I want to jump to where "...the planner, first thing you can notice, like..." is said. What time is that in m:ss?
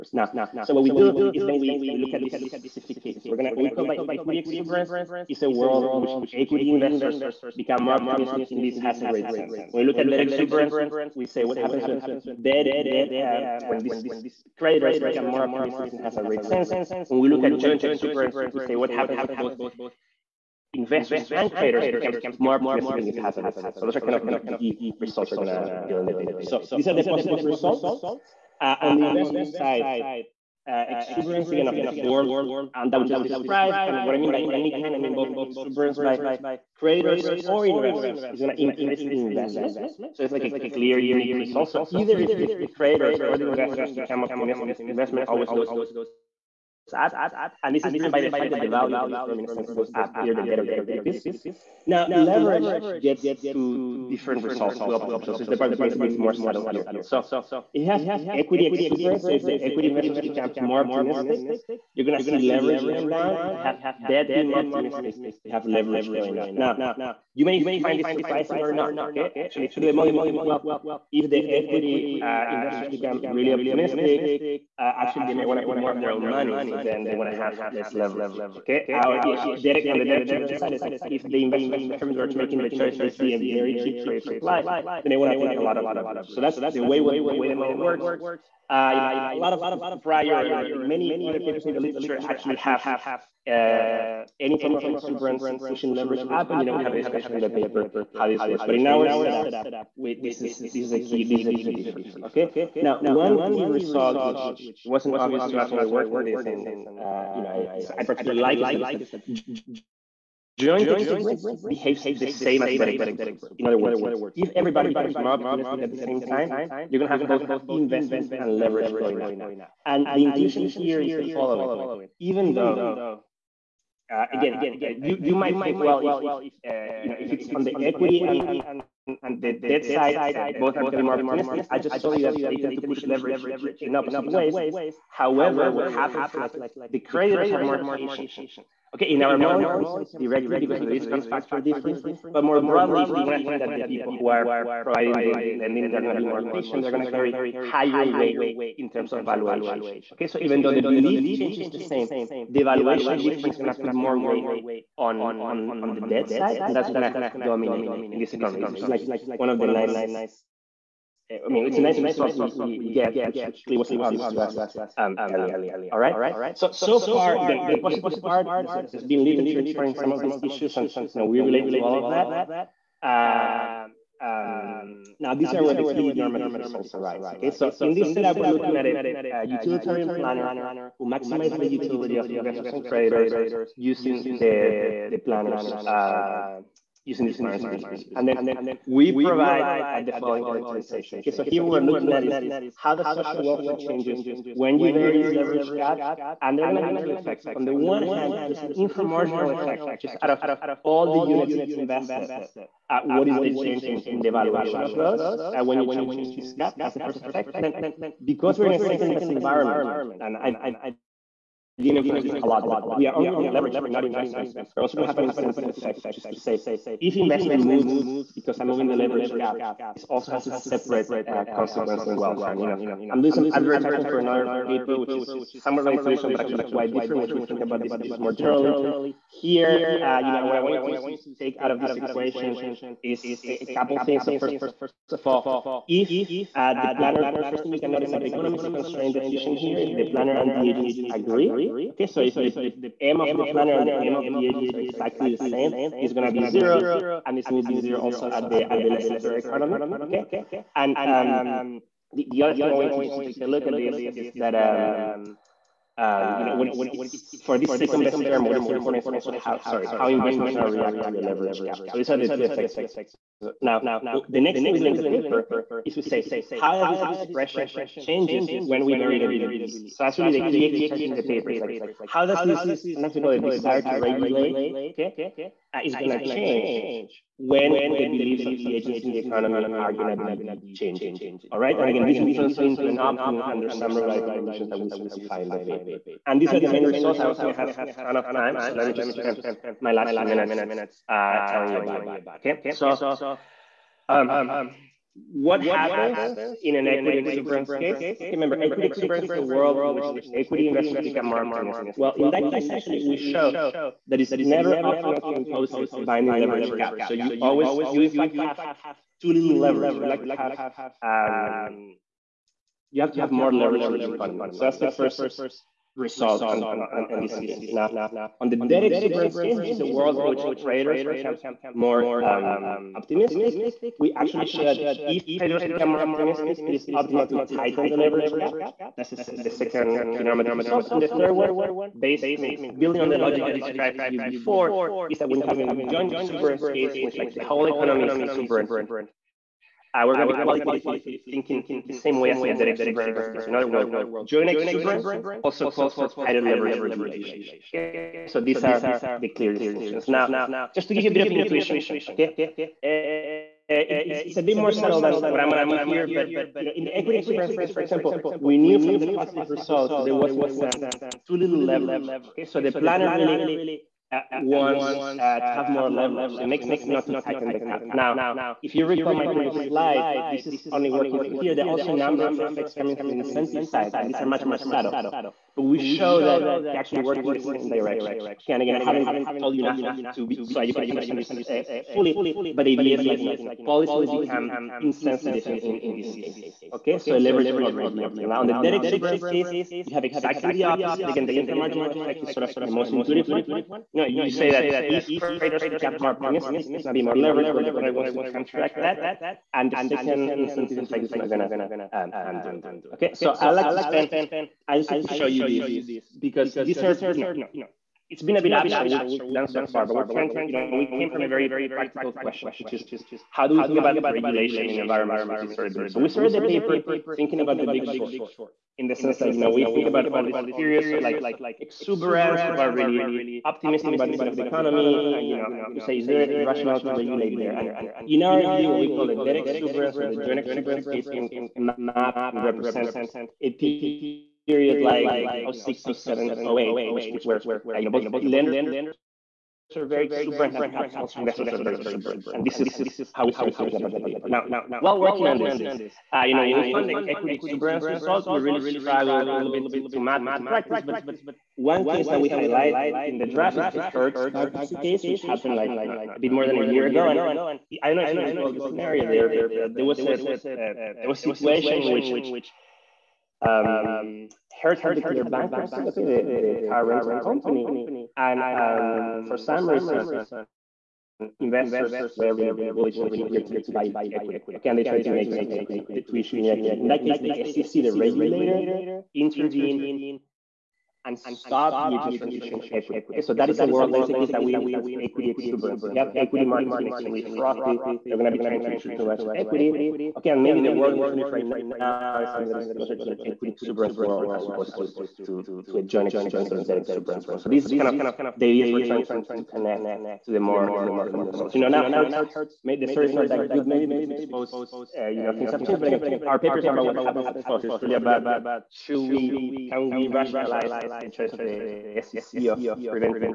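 3:56.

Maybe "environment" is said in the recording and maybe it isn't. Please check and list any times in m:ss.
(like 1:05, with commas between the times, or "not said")
3:29, 6:54.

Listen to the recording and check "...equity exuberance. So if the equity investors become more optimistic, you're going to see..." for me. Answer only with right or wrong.
right.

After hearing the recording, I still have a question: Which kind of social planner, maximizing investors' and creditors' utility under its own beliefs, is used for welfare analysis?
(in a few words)
Utilitarian planner.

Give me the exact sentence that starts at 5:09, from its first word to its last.
You like to have um, you have to have more leverage in the economy.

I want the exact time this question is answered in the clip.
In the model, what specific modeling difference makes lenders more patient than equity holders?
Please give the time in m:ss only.
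2:20.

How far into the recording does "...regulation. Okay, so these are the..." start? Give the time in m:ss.
5:46.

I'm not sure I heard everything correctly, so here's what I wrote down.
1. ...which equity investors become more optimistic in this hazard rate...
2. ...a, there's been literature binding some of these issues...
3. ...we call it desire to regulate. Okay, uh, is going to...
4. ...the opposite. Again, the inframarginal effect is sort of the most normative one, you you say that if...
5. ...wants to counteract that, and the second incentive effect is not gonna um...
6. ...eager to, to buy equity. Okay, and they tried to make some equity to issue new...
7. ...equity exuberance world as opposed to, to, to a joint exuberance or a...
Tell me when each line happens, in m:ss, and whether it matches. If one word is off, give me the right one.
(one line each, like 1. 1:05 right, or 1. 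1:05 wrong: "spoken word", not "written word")
1. 0:06 right
2. 2:48 wrong: "exploring", not "binding"
3. 4:33 right
4. 6:30 wrong: "intuitive", not "normative"
5. 6:37 right
6. 7:53 right
7. 8:13 right.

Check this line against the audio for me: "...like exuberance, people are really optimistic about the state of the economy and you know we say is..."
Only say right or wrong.
right.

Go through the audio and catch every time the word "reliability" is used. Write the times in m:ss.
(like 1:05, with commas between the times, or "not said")
4:43.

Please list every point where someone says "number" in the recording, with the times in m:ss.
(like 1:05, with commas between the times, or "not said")
6:11.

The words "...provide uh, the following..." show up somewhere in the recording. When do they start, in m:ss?
3:09.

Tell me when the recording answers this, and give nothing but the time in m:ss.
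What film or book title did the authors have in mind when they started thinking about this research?
6:57.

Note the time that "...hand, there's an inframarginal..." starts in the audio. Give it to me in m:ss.
3:18.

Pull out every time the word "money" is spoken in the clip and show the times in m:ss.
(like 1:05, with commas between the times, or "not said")
1:16.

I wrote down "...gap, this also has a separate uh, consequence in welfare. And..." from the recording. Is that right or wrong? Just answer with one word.
right.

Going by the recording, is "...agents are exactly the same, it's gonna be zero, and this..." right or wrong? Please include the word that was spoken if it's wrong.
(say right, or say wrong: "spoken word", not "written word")
right.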